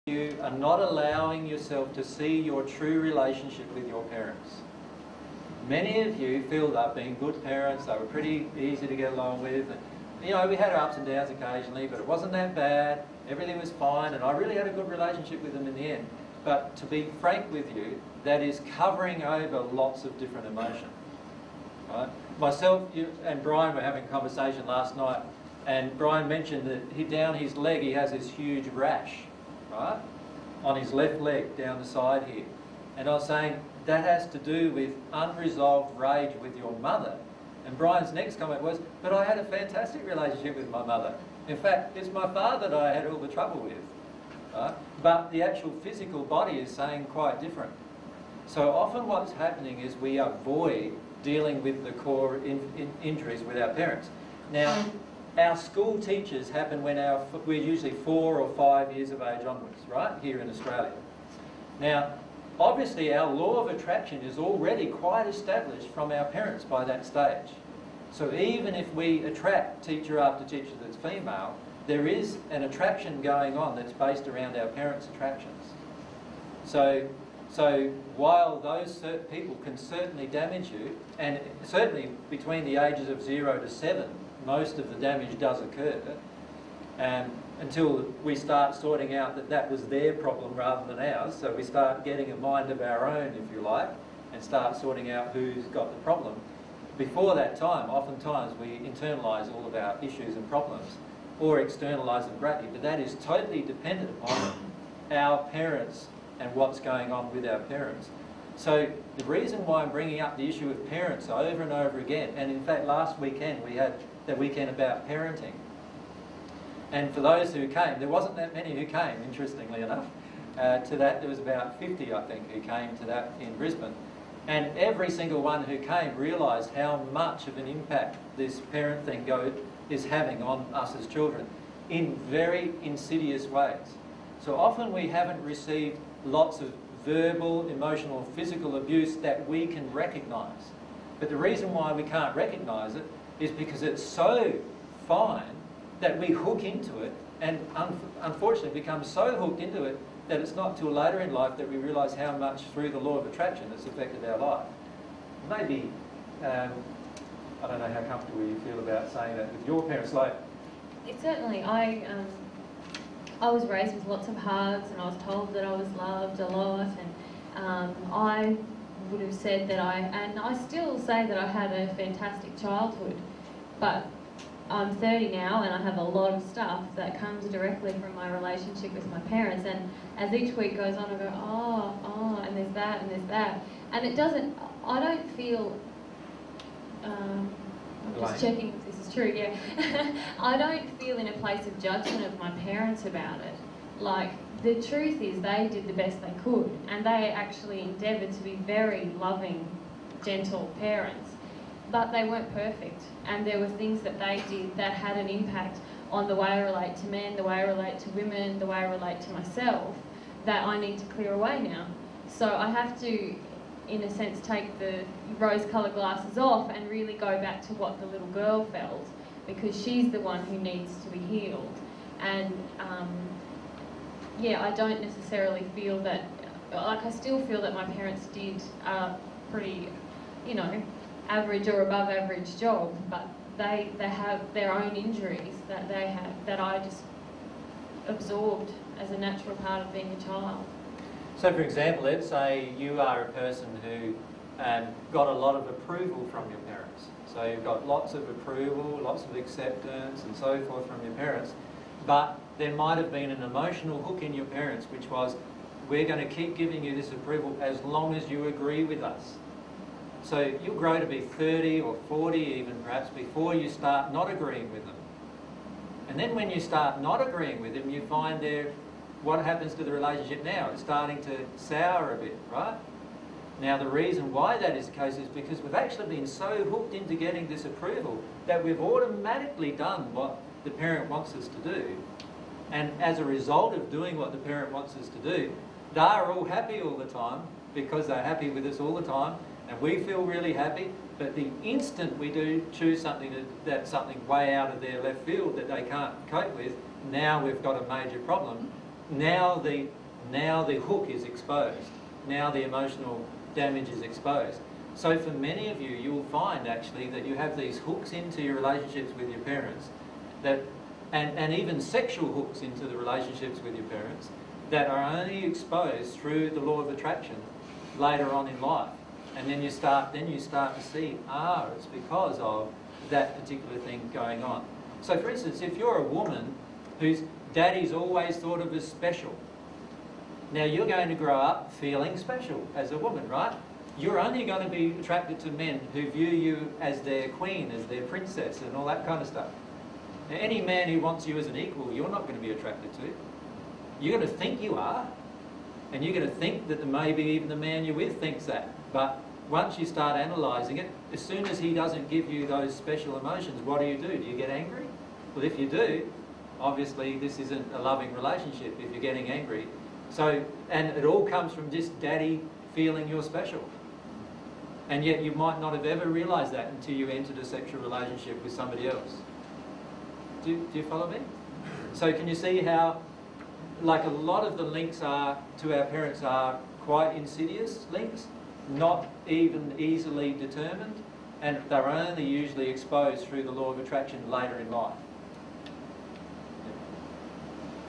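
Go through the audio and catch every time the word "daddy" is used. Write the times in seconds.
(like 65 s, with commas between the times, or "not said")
327 s, 361 s.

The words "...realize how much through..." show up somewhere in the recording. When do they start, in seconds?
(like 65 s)
151 s.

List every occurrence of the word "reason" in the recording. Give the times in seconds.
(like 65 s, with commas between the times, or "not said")
109 s, 141 s, 273 s.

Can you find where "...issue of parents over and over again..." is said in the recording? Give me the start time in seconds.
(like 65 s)
110 s.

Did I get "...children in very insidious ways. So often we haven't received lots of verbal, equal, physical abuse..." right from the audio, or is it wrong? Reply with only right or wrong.
wrong.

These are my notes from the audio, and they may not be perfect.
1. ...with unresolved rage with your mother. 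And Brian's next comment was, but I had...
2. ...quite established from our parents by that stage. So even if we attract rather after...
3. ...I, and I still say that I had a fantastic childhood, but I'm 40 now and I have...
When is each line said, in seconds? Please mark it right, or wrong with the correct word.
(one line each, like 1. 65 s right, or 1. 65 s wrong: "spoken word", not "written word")
1. 34 s right
2. 64 s wrong: "teacher", not "rather"
3. 169 s wrong: "30", not "40".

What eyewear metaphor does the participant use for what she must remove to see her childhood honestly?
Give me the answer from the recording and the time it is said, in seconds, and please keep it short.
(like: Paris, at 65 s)
rose-coloured glasses, at 215 s.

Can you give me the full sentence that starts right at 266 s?
And then when you start not agreeing with them, you find they're what happens to the relationship now?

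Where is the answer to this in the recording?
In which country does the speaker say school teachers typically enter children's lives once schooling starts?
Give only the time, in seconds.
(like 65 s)
60 s.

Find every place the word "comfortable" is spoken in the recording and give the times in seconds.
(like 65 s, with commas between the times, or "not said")
158 s.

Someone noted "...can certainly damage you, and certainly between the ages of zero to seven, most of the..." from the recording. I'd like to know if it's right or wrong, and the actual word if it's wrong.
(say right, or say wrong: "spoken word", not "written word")
right.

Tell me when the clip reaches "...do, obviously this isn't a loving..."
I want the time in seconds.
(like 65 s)
355 s.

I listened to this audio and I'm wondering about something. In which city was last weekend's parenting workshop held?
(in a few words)
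Brisbane.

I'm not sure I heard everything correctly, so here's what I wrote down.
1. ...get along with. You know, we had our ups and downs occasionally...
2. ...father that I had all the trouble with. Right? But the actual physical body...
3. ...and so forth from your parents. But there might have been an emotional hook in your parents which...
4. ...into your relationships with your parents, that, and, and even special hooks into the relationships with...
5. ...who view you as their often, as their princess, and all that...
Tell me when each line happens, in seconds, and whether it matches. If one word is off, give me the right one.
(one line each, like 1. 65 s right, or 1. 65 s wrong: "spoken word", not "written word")
1. 8 s right
2. 42 s right
3. 250 s right
4. 308 s wrong: "sexual", not "special"
5. 335 s wrong: "queen", not "often".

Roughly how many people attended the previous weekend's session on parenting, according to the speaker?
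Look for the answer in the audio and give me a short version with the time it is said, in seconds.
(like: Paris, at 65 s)
50, at 121 s.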